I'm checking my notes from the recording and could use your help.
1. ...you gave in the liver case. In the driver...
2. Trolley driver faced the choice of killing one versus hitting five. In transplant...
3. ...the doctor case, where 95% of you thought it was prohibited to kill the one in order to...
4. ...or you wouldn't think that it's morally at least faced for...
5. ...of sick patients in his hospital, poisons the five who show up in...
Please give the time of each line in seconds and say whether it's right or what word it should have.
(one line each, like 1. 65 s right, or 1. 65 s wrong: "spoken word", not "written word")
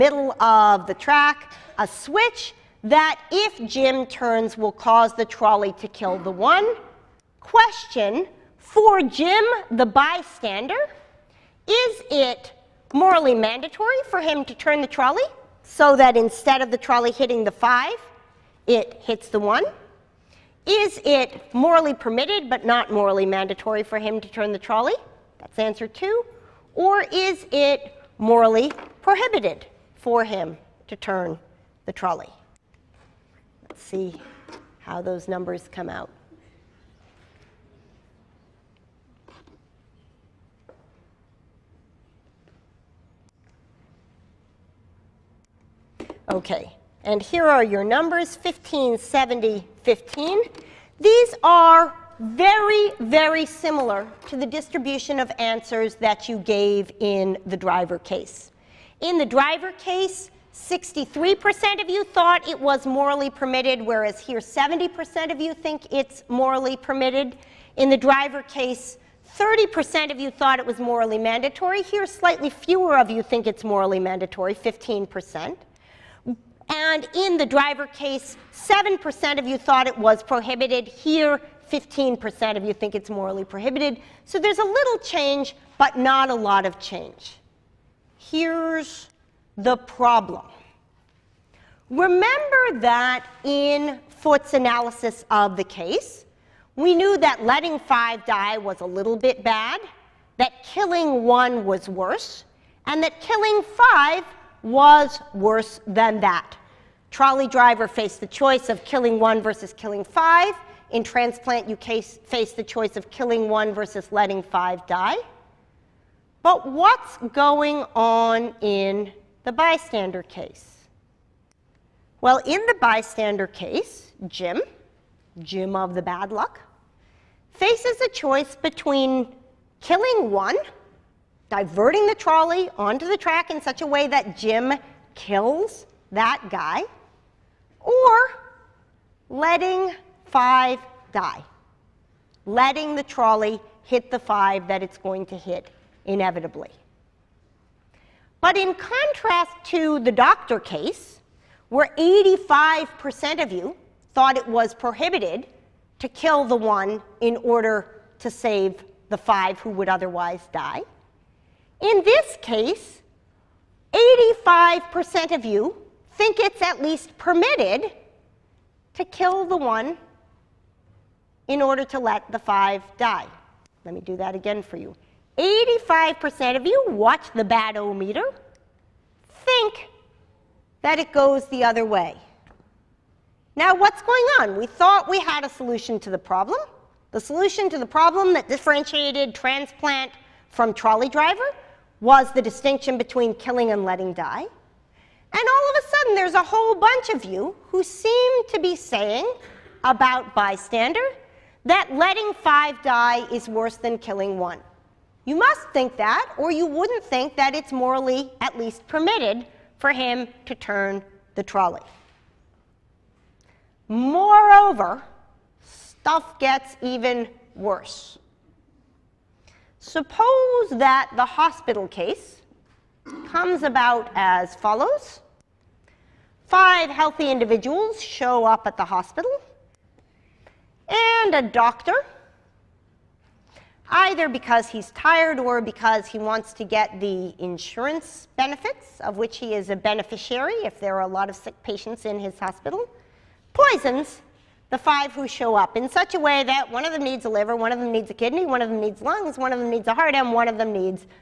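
1. 56 s wrong: "driver", not "liver"
2. 107 s wrong: "killing", not "hitting"
3. 149 s wrong: "85", not "95"
4. 206 s wrong: "permitted", not "faced"
5. 241 s right.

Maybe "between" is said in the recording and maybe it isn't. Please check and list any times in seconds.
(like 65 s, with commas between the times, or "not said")
128 s, 192 s.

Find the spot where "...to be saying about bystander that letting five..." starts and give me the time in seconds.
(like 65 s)
198 s.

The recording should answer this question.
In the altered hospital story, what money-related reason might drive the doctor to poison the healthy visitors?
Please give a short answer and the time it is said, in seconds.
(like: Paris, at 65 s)
insurance benefits, at 237 s.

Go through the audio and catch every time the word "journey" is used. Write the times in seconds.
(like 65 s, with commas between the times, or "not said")
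not said.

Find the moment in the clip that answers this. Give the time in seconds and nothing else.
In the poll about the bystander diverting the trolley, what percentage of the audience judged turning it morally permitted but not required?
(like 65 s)
64 s.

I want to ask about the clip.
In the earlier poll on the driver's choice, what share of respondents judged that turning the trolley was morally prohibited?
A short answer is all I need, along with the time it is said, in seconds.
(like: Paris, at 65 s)
7%, at 78 s.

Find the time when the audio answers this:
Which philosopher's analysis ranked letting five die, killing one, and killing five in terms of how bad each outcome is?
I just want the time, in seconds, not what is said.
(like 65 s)
94 s.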